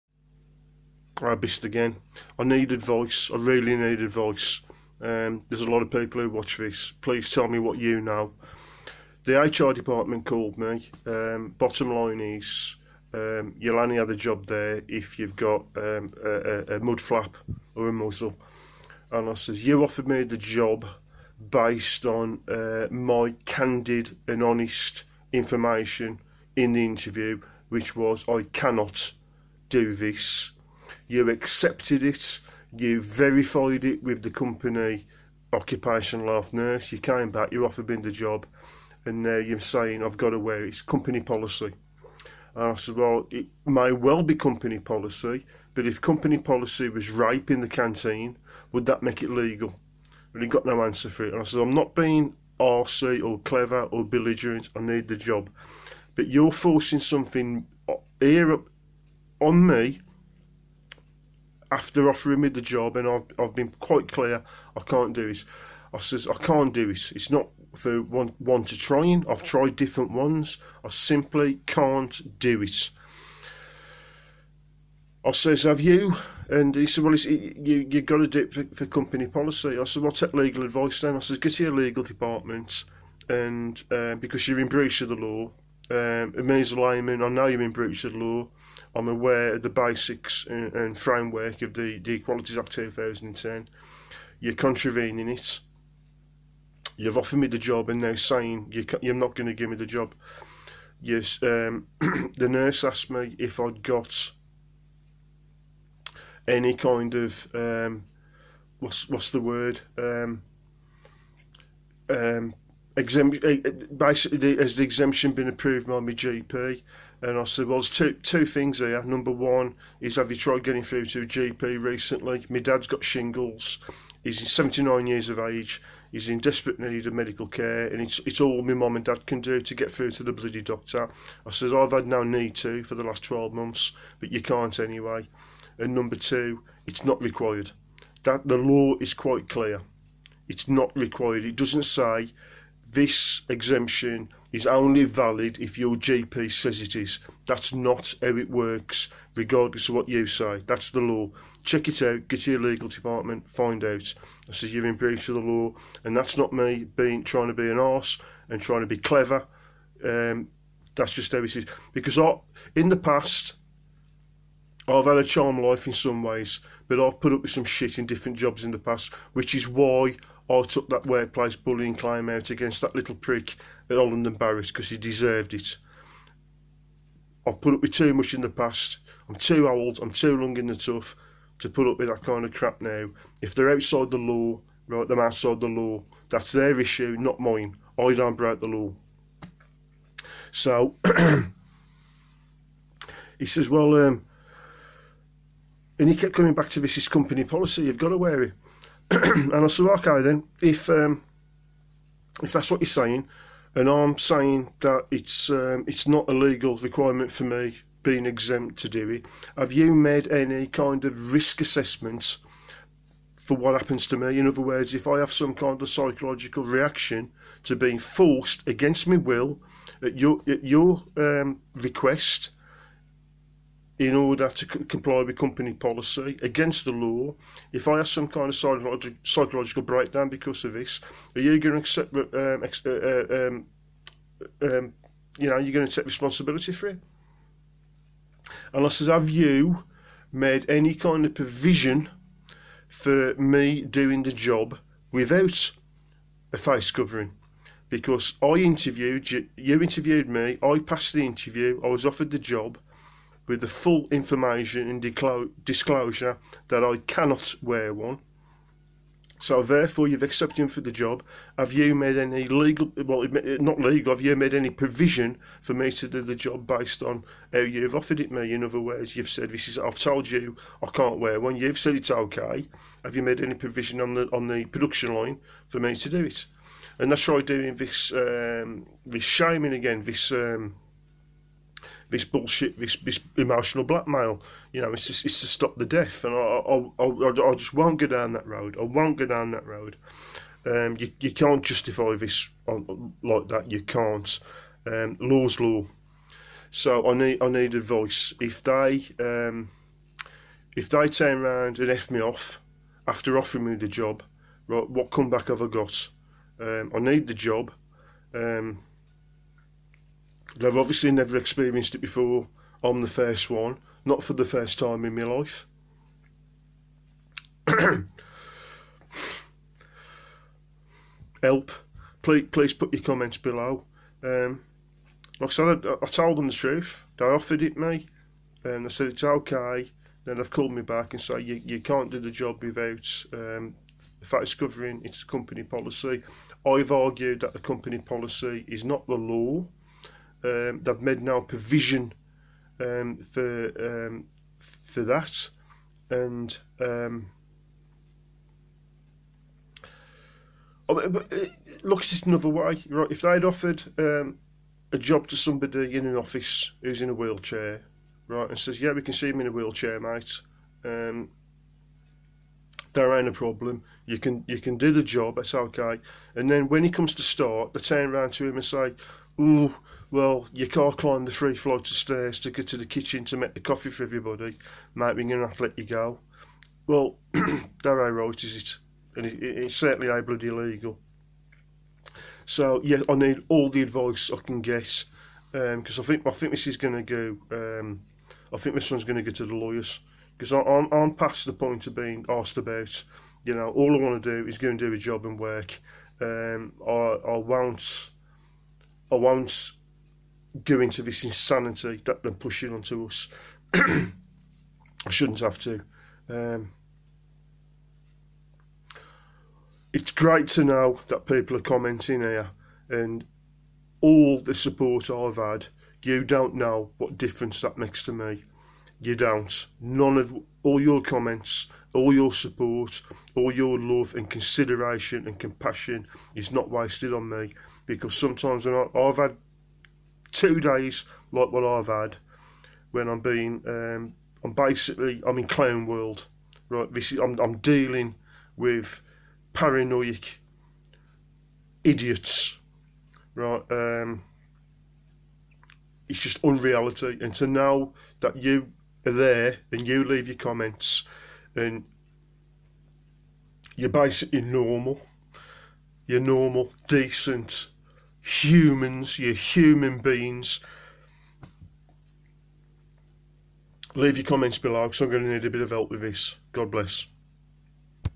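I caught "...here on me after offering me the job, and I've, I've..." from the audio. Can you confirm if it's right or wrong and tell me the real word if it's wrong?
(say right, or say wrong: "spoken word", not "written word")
right.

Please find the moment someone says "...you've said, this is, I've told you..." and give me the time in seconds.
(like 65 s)
269 s.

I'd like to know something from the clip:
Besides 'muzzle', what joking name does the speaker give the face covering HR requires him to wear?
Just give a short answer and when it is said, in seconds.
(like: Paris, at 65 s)
mud flap, at 16 s.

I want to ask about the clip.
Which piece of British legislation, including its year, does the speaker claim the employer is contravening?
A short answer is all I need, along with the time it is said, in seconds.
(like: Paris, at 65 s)
Equalities Act 2010, at 92 s.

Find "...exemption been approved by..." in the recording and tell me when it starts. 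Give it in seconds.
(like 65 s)
114 s.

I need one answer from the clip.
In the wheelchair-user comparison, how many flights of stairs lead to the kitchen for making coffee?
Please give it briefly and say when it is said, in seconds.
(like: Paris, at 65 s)
3, at 371 s.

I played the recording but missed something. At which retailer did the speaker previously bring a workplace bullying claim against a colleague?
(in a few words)
Holland and Barrett.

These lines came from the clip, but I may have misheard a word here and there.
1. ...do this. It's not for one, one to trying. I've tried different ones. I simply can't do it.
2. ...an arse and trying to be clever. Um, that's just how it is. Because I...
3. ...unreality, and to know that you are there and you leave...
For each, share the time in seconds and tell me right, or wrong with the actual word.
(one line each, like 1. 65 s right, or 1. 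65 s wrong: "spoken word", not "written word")
1. 66 s right
2. 157 s right
3. 446 s right.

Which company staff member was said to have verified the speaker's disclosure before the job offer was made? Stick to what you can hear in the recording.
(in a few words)
occupational health nurse.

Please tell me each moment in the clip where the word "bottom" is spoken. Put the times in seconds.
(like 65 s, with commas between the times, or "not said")
11 s.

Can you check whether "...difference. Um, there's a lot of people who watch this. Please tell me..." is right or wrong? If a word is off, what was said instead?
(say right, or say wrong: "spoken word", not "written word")
wrong: "advice", not "difference".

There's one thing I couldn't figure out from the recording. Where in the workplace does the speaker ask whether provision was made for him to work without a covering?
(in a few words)
production line.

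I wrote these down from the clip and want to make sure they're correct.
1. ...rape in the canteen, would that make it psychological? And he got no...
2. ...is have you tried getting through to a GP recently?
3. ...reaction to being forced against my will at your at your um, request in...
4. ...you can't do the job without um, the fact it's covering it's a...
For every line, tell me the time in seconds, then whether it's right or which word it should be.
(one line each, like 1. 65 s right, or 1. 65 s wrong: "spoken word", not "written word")
1. 47 s wrong: "legal", not "psychological"
2. 120 s right
3. 216 s right
4. 331 s right.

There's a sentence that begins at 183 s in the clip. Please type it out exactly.
If they're outside the law, right, they're outside the law.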